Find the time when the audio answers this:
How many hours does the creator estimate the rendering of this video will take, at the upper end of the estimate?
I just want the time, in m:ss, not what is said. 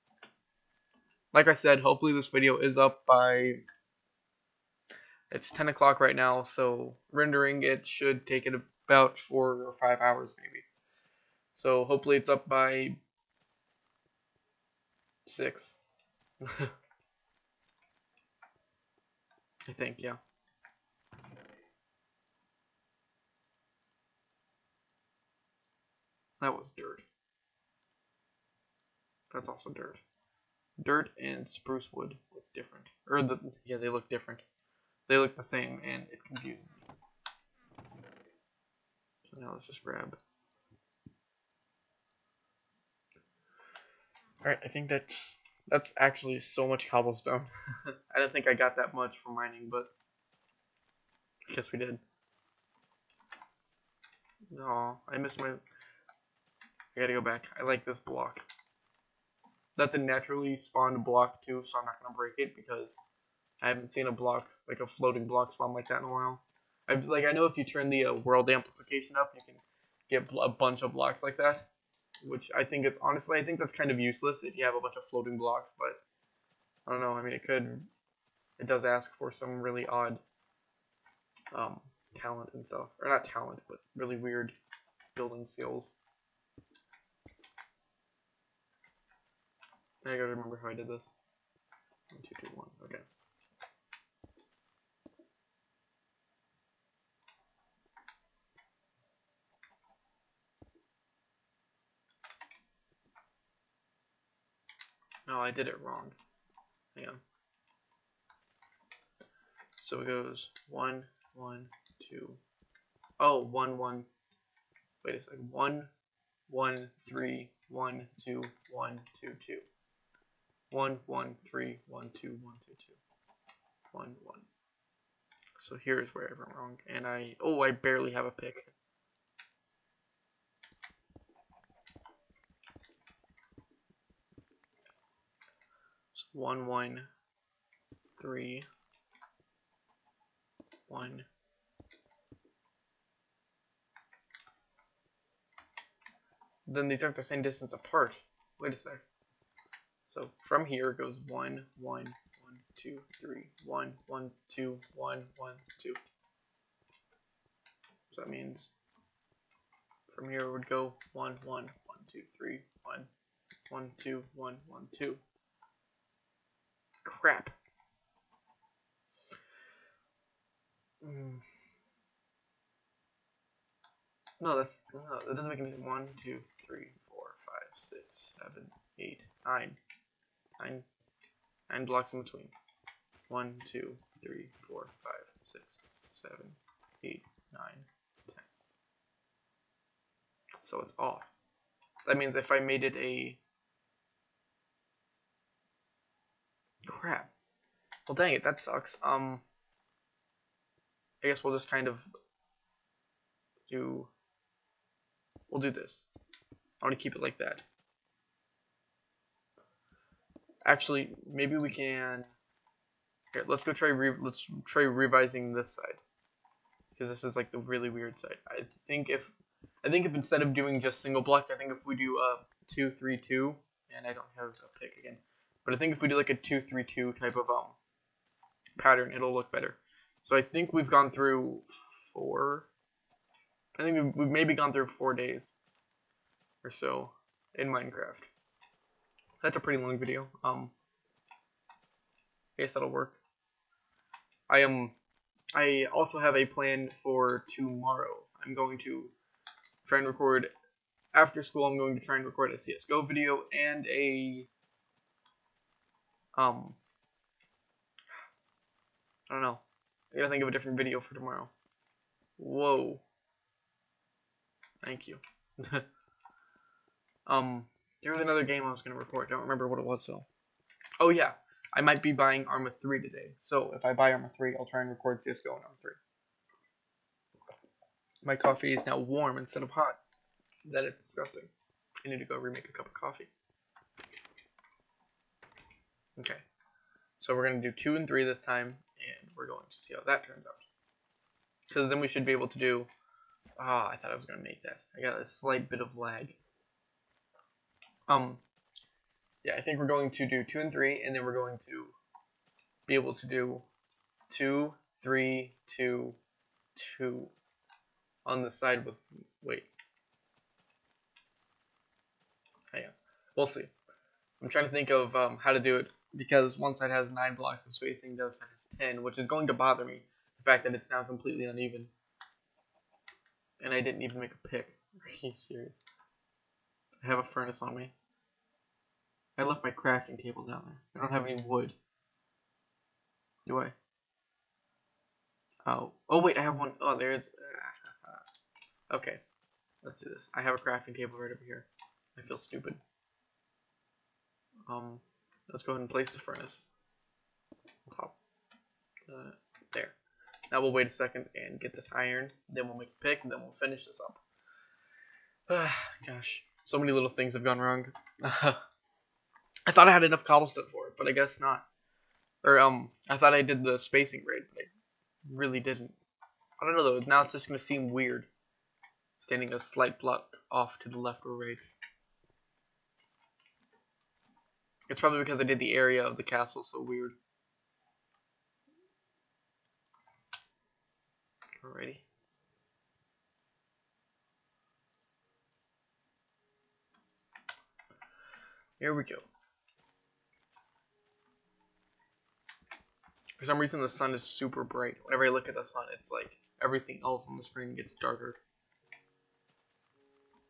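0:09.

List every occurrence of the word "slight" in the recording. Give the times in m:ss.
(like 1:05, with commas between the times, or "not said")
4:55, 6:09.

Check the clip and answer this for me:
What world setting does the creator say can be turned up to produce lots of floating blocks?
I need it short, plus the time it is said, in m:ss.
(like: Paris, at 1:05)
world amplification, at 1:08.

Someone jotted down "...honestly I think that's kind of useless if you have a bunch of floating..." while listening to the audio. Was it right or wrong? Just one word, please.
right.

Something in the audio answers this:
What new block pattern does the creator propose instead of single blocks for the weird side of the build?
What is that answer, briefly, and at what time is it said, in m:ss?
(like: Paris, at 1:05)
2-3-2, at 3:46.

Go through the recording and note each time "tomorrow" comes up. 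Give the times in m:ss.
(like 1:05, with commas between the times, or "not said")
4:07, 4:21.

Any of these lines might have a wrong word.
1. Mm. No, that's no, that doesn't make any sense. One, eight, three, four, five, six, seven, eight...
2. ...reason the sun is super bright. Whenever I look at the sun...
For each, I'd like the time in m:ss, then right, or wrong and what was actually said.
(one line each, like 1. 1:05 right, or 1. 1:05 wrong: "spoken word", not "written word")
1. 2:51 wrong: "two", not "eight"
2. 6:33 right.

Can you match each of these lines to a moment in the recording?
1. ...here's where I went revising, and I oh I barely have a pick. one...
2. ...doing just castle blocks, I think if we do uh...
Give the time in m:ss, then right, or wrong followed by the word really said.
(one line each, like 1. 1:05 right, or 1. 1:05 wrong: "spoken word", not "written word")
1. 2:05 wrong: "wrong", not "revising"
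2. 3:40 wrong: "single", not "castle".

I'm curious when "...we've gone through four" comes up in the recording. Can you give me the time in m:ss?
3:50.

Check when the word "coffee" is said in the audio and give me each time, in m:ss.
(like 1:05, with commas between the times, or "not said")
4:38, 4:42.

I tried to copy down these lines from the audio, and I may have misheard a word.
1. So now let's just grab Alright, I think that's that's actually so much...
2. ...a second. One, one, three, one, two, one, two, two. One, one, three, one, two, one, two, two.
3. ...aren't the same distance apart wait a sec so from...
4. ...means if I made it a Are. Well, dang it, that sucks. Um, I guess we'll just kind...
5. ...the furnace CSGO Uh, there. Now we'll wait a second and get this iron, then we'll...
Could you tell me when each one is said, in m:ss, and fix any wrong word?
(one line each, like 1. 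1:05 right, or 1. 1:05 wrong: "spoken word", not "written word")
1. 0:39 right
2. 1:55 right
3. 2:27 right
4. 3:12 wrong: "Crap", not "Are"
5. 5:46 wrong: "Hop", not "CSGO".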